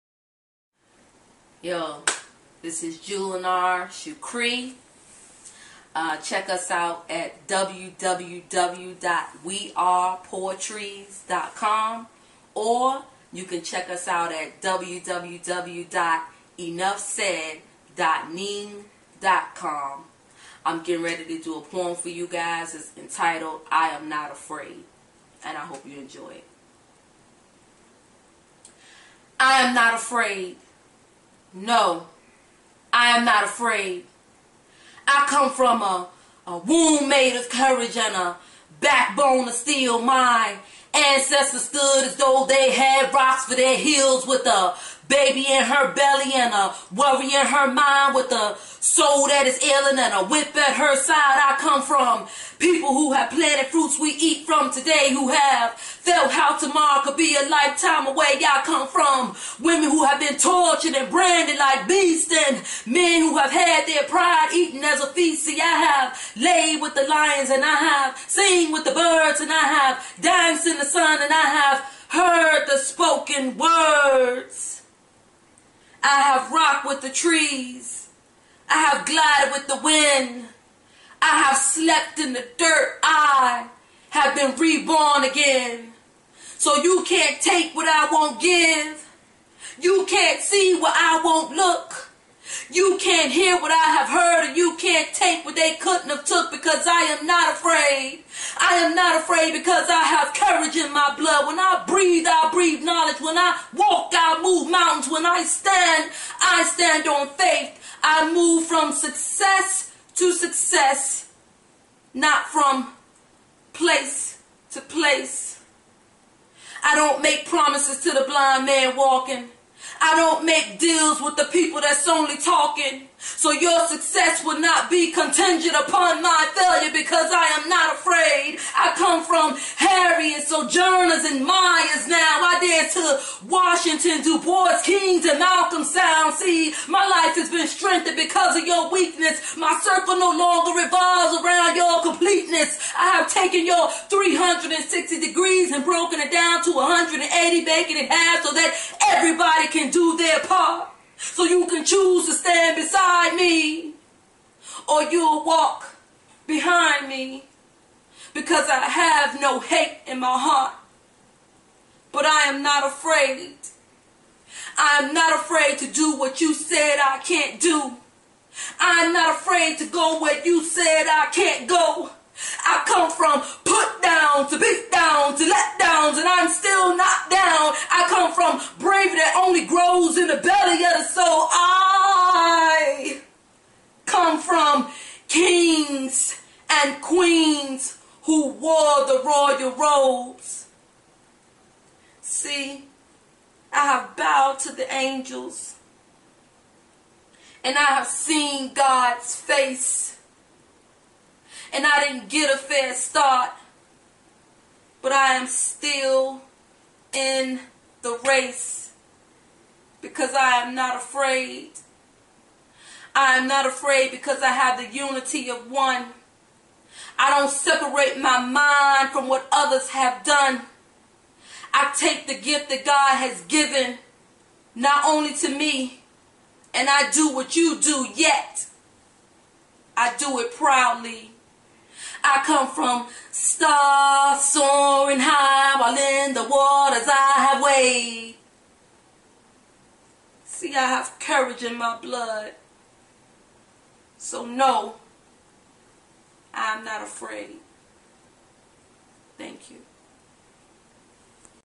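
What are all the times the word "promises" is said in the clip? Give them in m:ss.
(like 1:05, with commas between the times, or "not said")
1:57.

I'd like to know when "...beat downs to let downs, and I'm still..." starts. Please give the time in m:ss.
2:54.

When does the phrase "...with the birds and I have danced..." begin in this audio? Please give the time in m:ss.
1:08.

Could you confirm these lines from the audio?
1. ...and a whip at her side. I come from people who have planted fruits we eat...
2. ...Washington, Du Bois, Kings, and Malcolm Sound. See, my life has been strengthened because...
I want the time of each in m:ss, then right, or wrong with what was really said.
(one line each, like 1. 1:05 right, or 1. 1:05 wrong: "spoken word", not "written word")
1. 0:49 right
2. 2:13 right.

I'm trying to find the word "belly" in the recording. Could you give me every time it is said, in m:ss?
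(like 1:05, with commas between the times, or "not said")
0:45, 3:00.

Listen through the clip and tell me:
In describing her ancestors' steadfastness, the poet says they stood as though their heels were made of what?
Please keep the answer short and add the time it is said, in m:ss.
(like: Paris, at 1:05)
rocks, at 0:43.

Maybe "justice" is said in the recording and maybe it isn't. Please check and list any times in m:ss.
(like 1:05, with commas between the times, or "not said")
not said.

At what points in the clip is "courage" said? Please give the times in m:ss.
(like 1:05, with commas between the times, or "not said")
0:37, 1:40, 4:01.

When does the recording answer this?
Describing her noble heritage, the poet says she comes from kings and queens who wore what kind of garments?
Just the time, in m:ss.
3:09.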